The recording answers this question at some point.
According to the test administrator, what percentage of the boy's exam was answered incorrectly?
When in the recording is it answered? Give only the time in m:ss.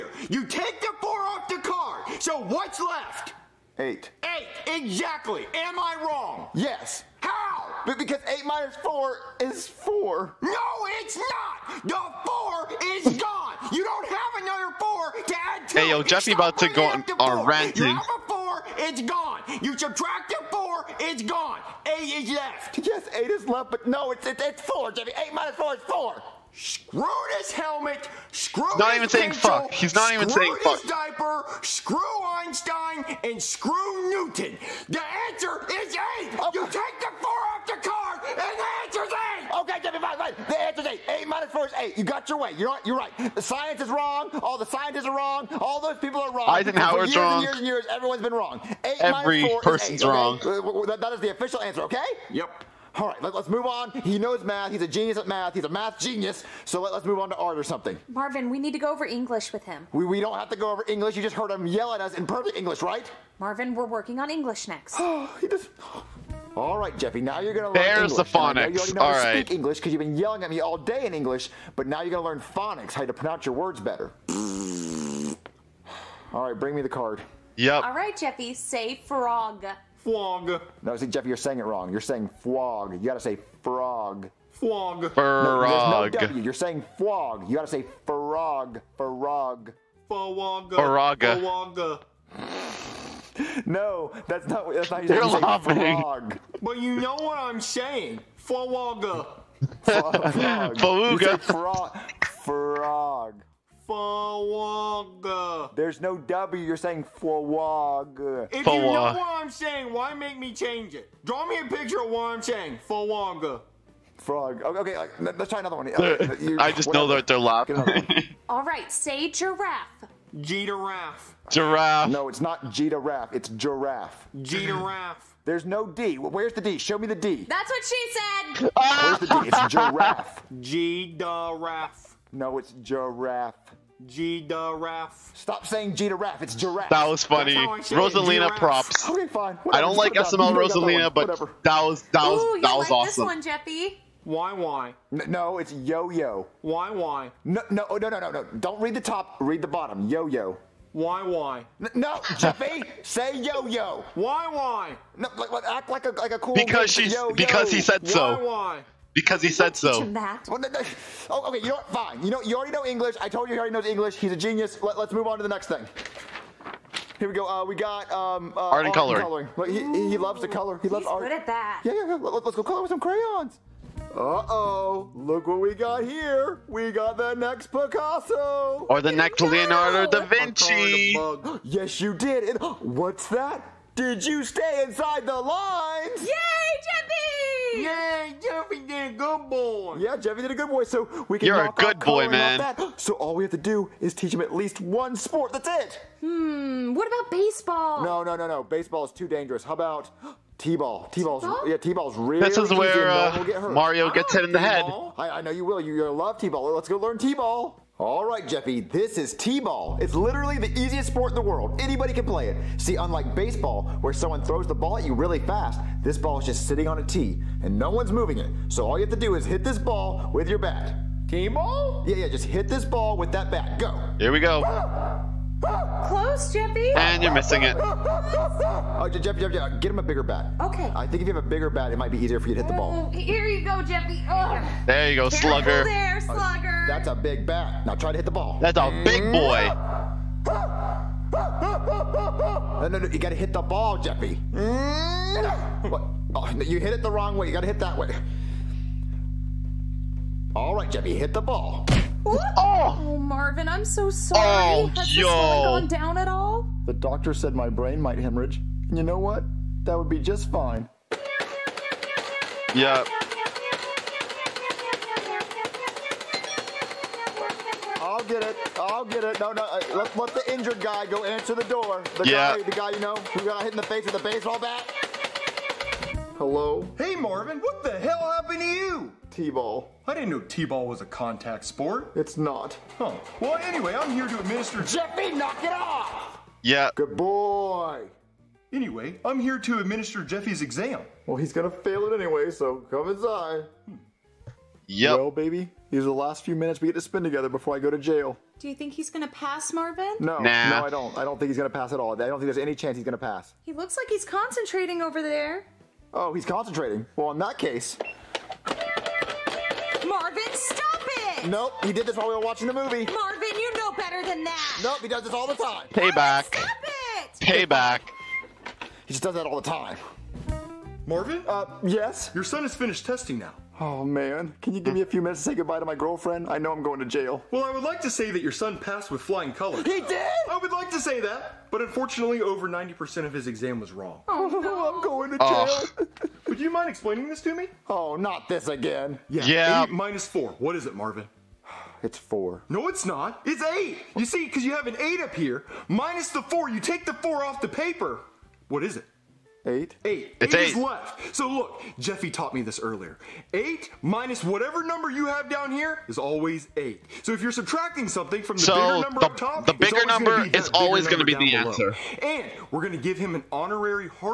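5:32.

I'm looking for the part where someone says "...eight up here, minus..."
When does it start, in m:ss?
5:45.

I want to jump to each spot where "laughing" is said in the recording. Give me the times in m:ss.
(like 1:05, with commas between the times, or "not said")
1:35, 1:57.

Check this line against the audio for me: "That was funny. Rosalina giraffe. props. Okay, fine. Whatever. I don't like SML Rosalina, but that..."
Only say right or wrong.
right.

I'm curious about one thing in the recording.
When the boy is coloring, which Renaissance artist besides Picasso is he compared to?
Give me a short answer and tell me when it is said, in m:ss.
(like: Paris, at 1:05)
Leonardo da Vinci, at 2:59.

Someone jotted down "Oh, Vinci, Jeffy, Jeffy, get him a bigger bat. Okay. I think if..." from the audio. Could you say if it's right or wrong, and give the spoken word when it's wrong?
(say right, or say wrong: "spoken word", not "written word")
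wrong: "Jeffy", not "Vinci".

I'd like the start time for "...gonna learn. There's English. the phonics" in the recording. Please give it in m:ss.
1:07.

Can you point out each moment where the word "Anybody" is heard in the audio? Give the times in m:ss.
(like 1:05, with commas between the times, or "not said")
3:31.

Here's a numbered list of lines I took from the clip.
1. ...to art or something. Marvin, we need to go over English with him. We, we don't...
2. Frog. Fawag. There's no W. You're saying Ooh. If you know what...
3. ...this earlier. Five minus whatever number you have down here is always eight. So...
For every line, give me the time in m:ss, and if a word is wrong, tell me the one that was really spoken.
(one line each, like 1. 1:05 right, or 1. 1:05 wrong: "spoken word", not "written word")
1. 0:57 right
2. 1:42 wrong: "Fawag", not "Ooh"
3. 5:52 wrong: "Eight", not "Five".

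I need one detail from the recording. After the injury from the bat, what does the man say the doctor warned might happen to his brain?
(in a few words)
hemorrhage.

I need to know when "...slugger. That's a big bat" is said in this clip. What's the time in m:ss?
3:56.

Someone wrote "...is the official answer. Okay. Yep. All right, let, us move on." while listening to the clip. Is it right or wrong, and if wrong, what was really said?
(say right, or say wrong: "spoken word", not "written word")
right.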